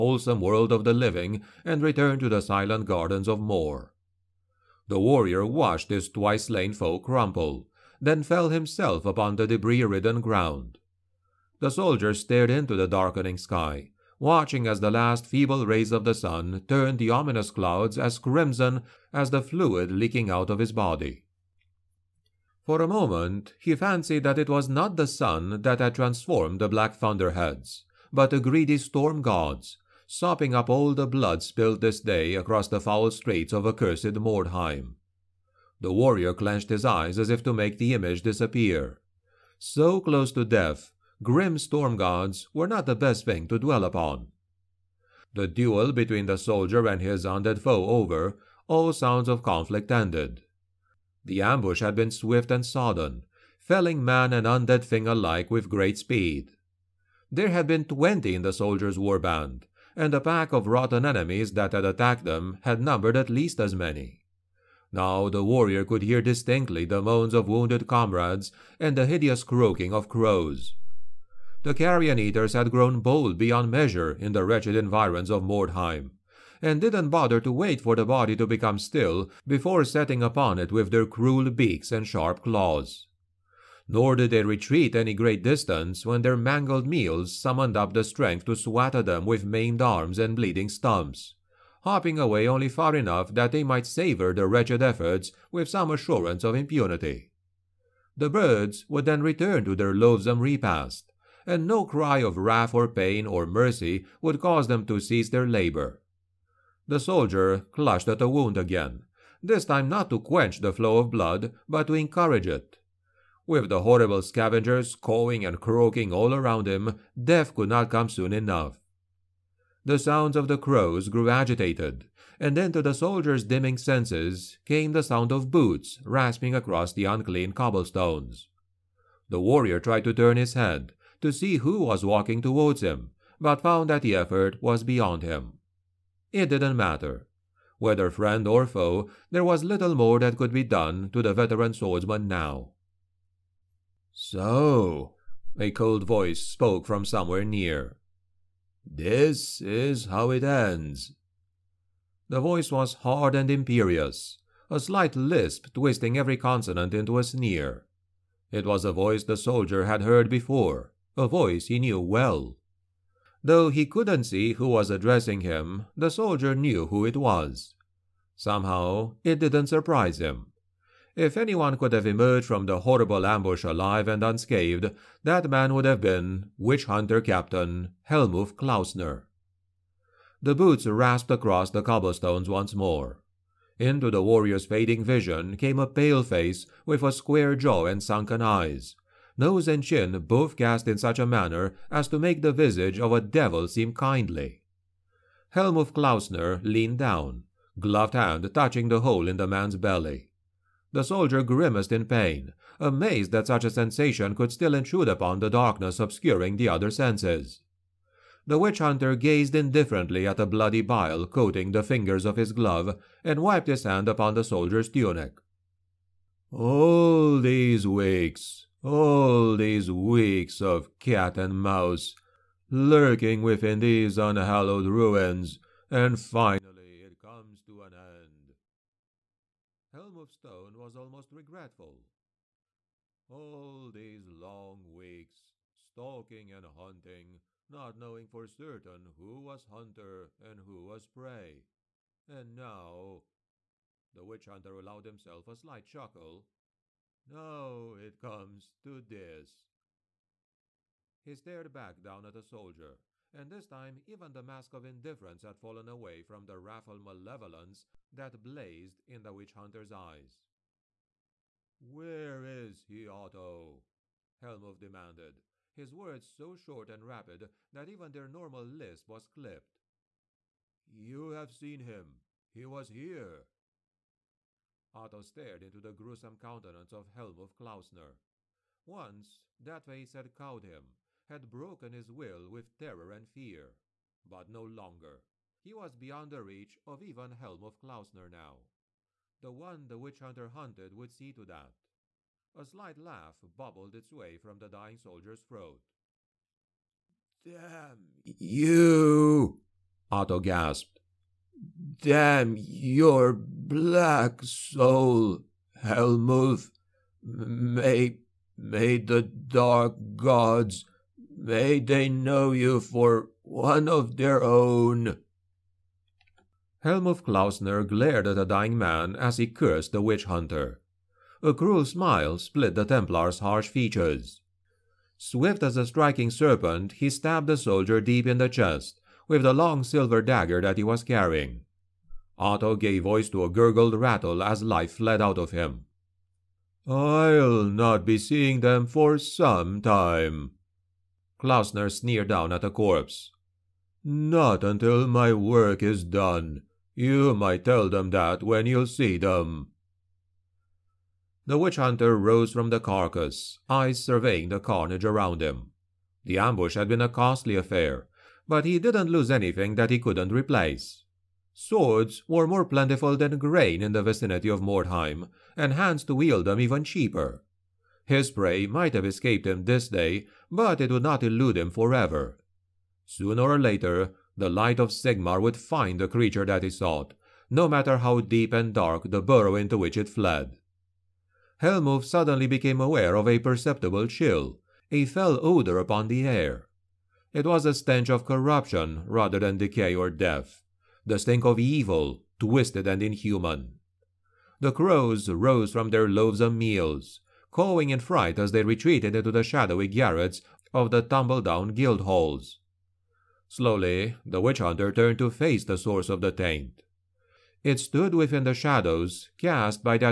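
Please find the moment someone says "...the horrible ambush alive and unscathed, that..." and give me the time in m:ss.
2:52.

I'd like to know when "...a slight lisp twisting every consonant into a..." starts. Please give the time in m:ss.
2:34.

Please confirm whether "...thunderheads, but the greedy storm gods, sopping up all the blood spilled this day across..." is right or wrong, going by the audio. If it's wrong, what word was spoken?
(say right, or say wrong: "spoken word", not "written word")
right.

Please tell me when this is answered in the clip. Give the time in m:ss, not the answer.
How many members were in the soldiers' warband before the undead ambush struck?
0:57.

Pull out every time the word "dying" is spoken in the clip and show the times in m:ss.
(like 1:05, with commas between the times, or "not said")
4:54, 5:18.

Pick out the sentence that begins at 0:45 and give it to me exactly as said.
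The duel between the soldier and his undead foe over, all sounds of conflict ended.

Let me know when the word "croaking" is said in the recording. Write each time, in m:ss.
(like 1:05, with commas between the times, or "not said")
1:09, 1:55.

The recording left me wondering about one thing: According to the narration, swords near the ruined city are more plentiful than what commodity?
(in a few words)
grain.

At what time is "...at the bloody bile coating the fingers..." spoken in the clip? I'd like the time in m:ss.
3:30.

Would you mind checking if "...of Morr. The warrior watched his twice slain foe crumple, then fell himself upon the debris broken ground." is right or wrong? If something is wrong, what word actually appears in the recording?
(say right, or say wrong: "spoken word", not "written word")
wrong: "ridden", not "broken".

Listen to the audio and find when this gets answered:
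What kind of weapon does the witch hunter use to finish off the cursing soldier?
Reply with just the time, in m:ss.
5:29.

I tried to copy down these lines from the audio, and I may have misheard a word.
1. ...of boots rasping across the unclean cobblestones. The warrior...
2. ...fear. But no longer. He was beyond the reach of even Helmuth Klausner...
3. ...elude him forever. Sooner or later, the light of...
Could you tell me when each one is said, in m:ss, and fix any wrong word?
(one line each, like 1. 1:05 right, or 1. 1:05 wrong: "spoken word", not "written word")
1. 2:05 right
2. 4:43 right
3. 6:11 right.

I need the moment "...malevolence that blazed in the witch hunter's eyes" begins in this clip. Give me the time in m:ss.
4:16.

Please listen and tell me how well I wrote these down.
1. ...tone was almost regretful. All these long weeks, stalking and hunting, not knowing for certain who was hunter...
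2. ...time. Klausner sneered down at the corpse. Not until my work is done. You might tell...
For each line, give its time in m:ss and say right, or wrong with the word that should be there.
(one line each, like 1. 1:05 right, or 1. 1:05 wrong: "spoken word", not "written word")
1. 3:50 right
2. 5:39 right.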